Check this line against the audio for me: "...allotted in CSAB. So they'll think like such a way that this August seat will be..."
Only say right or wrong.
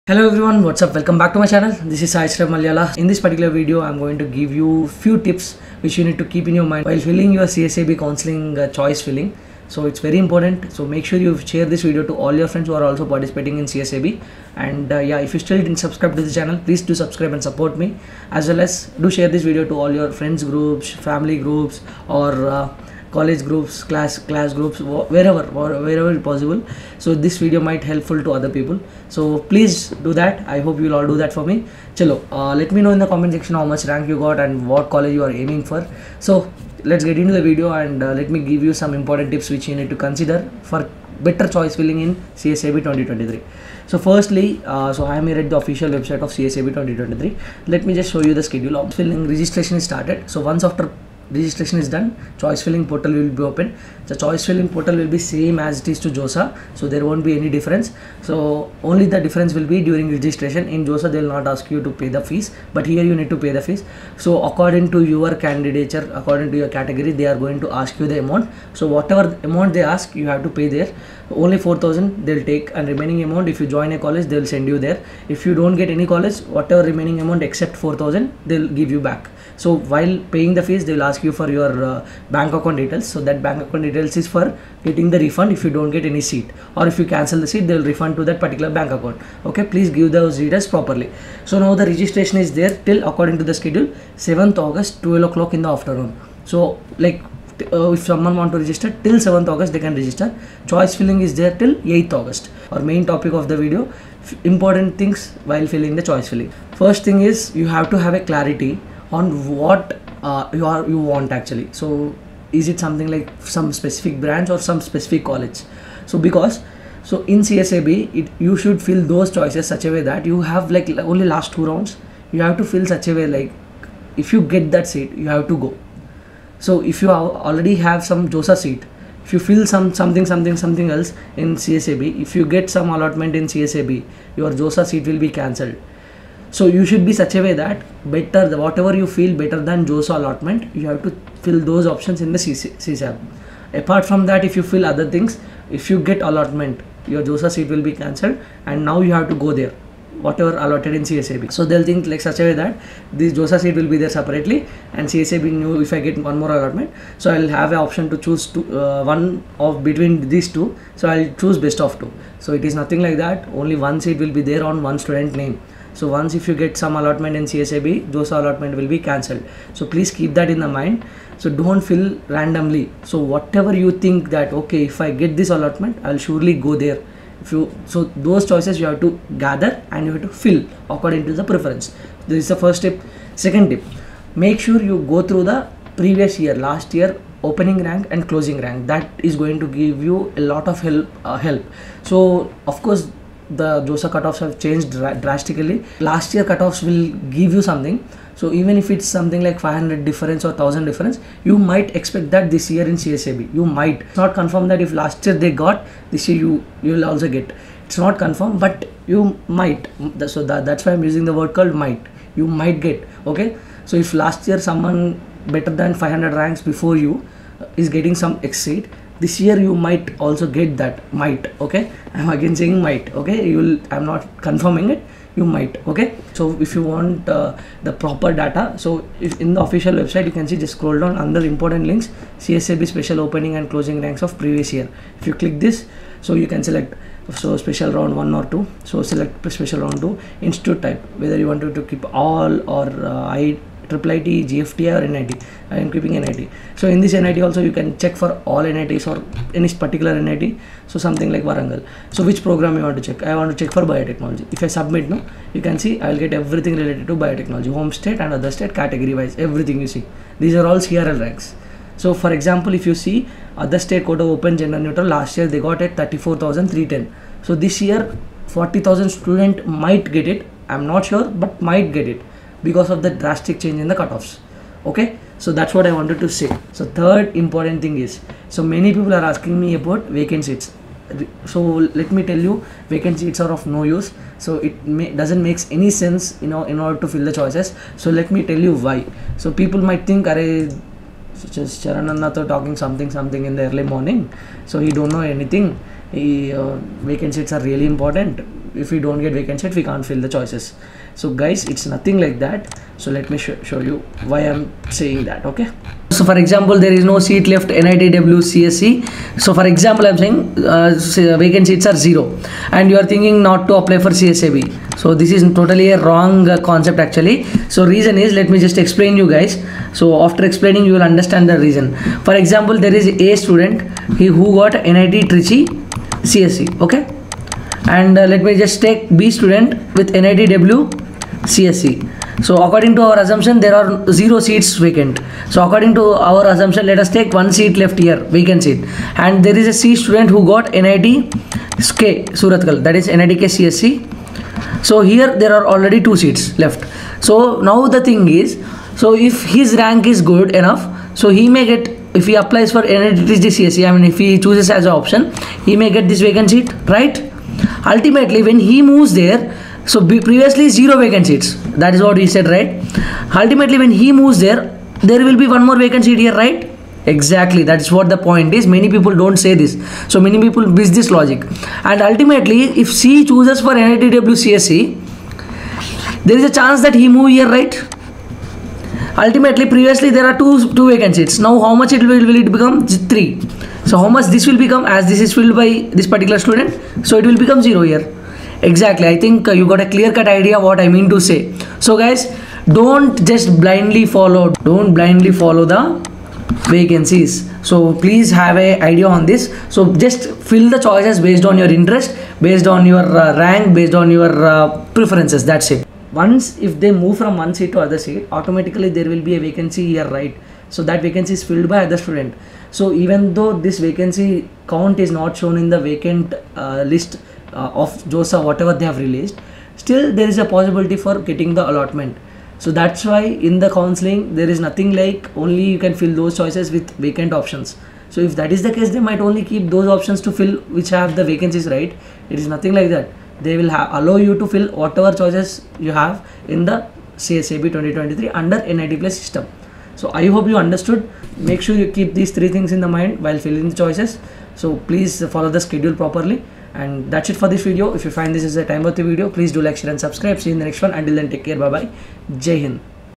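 wrong.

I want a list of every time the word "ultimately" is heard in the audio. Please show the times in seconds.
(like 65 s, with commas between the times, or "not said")
357 s, 363 s, 372 s, 379 s.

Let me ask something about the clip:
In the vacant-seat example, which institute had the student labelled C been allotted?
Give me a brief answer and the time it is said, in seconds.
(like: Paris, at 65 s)
NIT K Surathkal, at 340 s.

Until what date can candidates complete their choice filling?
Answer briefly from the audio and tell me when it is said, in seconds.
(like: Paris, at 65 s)
8th August, at 101 s.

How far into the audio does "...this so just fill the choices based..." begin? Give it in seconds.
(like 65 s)
399 s.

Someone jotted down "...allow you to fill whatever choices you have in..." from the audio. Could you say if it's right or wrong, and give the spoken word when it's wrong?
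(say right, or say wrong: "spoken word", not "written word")
right.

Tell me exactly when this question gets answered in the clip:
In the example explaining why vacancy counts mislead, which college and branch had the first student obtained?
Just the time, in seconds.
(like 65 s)
324 s.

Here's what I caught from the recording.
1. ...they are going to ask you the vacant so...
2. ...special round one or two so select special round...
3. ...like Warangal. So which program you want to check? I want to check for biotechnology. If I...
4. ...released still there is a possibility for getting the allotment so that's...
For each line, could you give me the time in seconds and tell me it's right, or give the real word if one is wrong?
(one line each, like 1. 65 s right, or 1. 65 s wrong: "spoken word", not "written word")
1. 67 s wrong: "amount", not "vacant"
2. 237 s right
3. 251 s right
4. 418 s right.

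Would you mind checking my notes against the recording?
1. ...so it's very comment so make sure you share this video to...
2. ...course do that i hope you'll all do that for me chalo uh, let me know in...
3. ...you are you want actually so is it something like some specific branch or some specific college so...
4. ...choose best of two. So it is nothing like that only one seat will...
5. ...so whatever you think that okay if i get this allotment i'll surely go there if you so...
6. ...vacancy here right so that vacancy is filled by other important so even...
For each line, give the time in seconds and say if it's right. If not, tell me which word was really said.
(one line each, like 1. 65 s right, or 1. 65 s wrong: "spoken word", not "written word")
1. 9 s wrong: "important", not "comment"
2. 29 s wrong: "please", not "course"
3. 110 s right
4. 161 s right
5. 173 s right
6. 409 s wrong: "student", not "important".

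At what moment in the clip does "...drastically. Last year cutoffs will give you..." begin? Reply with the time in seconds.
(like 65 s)
194 s.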